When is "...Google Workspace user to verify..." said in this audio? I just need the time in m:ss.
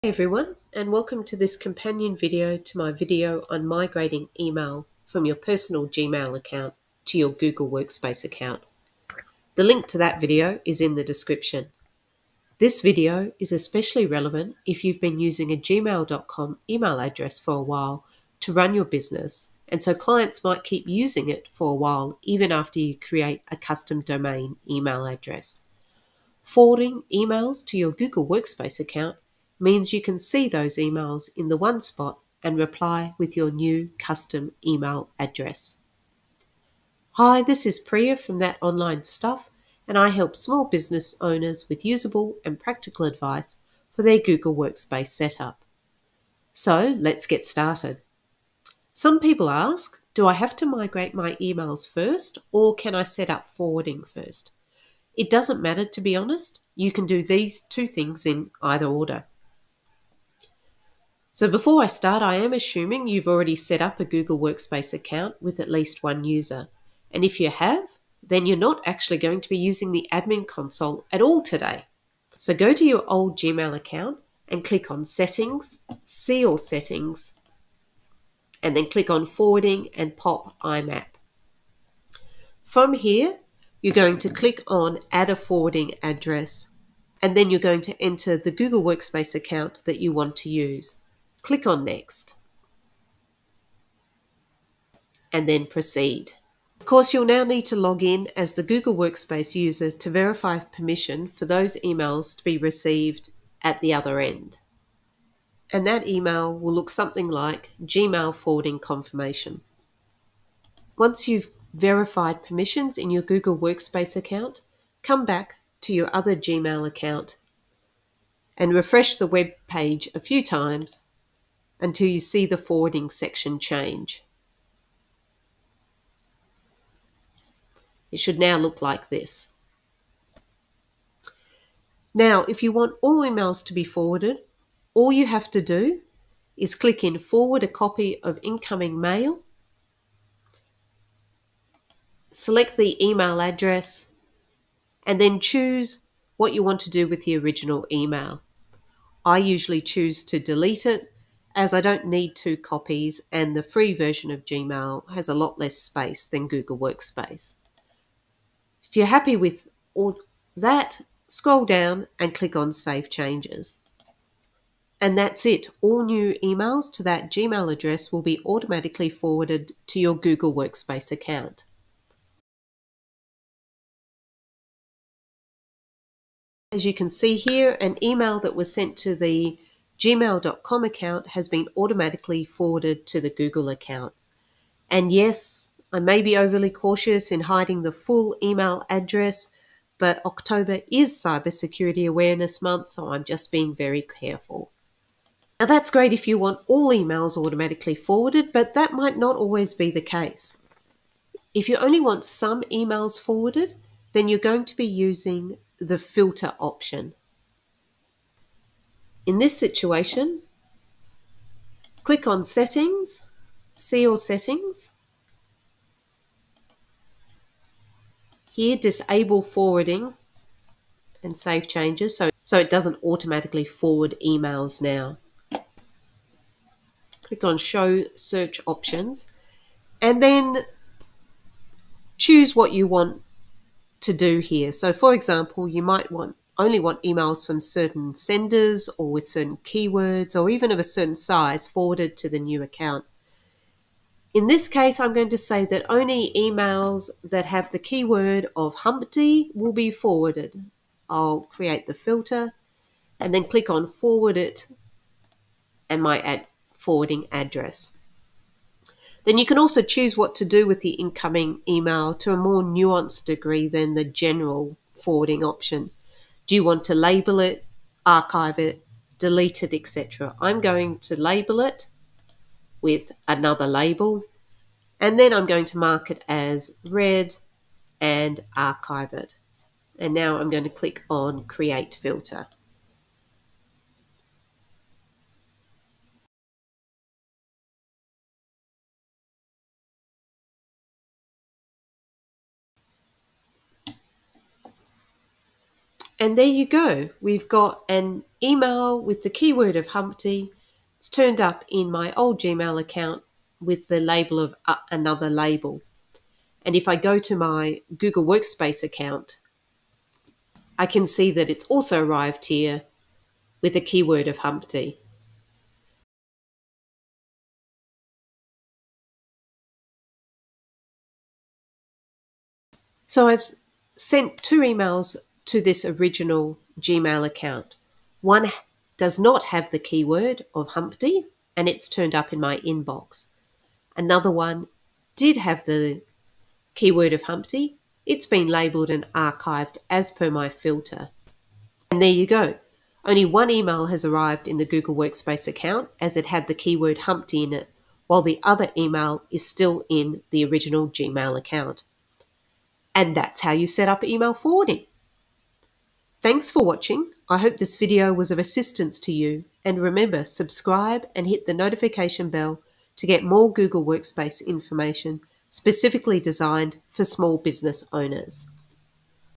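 1:38.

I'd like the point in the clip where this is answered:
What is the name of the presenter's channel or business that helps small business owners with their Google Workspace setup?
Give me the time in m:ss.
0:38.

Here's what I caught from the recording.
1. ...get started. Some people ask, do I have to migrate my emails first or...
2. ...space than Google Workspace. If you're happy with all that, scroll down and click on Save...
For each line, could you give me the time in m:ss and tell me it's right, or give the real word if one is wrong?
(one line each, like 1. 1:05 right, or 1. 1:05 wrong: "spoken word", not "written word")
1. 0:47 right
2. 2:35 right.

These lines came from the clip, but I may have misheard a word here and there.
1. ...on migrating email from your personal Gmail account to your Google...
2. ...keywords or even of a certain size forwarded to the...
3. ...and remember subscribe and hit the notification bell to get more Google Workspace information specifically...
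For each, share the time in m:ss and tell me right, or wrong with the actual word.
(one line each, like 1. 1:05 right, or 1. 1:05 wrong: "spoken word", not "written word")
1. 0:03 right
2. 3:59 right
3. 5:59 right.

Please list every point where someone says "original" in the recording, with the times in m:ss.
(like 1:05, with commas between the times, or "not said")
2:27, 5:25, 5:50.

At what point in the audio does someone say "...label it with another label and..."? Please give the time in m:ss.
4:31.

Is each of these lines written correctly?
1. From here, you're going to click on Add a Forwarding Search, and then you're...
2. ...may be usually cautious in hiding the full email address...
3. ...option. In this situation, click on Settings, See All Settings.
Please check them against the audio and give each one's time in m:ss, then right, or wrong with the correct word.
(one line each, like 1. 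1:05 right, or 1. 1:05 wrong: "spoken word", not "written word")
1. 1:22 wrong: "Address", not "Search"
2. 3:05 wrong: "overly", not "usually"
3. 3:26 right.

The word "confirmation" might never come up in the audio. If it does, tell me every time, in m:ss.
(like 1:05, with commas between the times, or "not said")
1:48.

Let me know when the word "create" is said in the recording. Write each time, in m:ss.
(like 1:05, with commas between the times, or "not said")
0:22, 4:11, 4:41.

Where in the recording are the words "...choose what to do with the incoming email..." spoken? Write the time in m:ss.
4:19.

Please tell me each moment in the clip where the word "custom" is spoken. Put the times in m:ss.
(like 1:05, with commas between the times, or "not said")
0:23, 0:33.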